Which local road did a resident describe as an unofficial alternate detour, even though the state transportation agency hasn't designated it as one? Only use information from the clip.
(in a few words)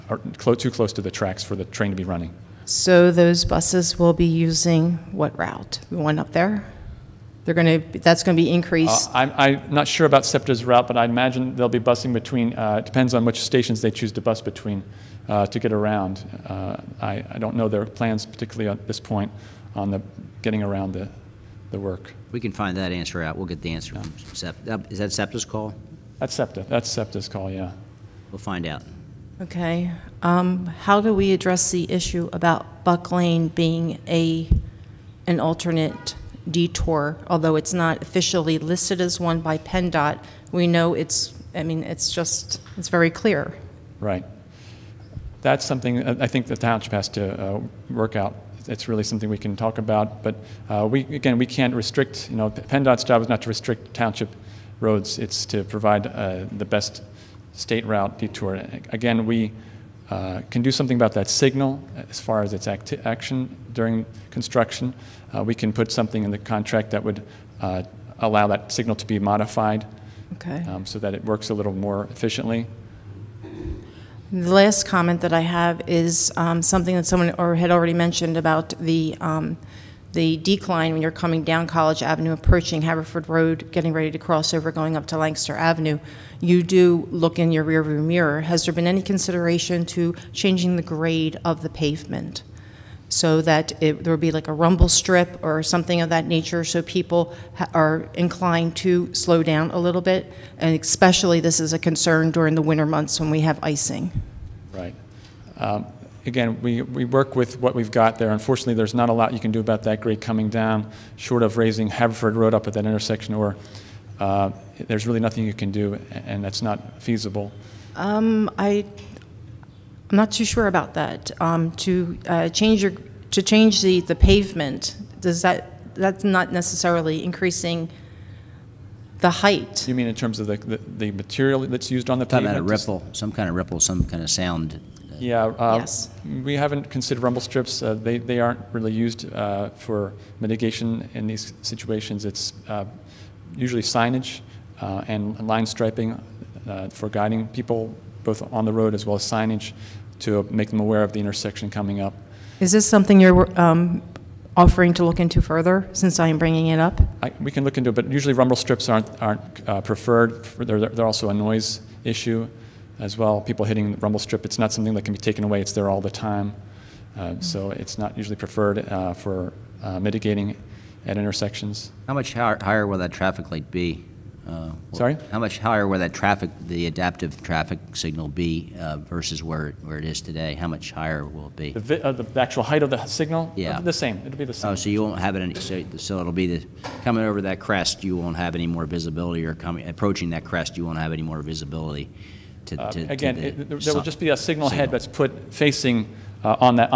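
Buck Lane.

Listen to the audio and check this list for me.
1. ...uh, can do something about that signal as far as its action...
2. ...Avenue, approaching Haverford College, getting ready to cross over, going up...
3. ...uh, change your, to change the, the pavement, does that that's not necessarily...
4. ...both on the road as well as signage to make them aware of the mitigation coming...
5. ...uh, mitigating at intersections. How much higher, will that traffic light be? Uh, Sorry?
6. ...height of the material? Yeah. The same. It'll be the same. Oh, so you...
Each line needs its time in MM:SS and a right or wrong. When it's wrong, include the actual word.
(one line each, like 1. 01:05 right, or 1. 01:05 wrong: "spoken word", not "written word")
1. 01:00 right
2. 01:22 wrong: "Road", not "College"
3. 02:02 right
4. 02:28 wrong: "intersection", not "mitigation"
5. 02:49 right
6. 03:02 wrong: "signal", not "material".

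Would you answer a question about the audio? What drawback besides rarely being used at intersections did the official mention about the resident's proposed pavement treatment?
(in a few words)
Noise issue.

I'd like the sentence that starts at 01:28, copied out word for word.
Has there been any consideration to changing the grade of the pavement?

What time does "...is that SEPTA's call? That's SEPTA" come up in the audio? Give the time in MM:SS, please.
00:24.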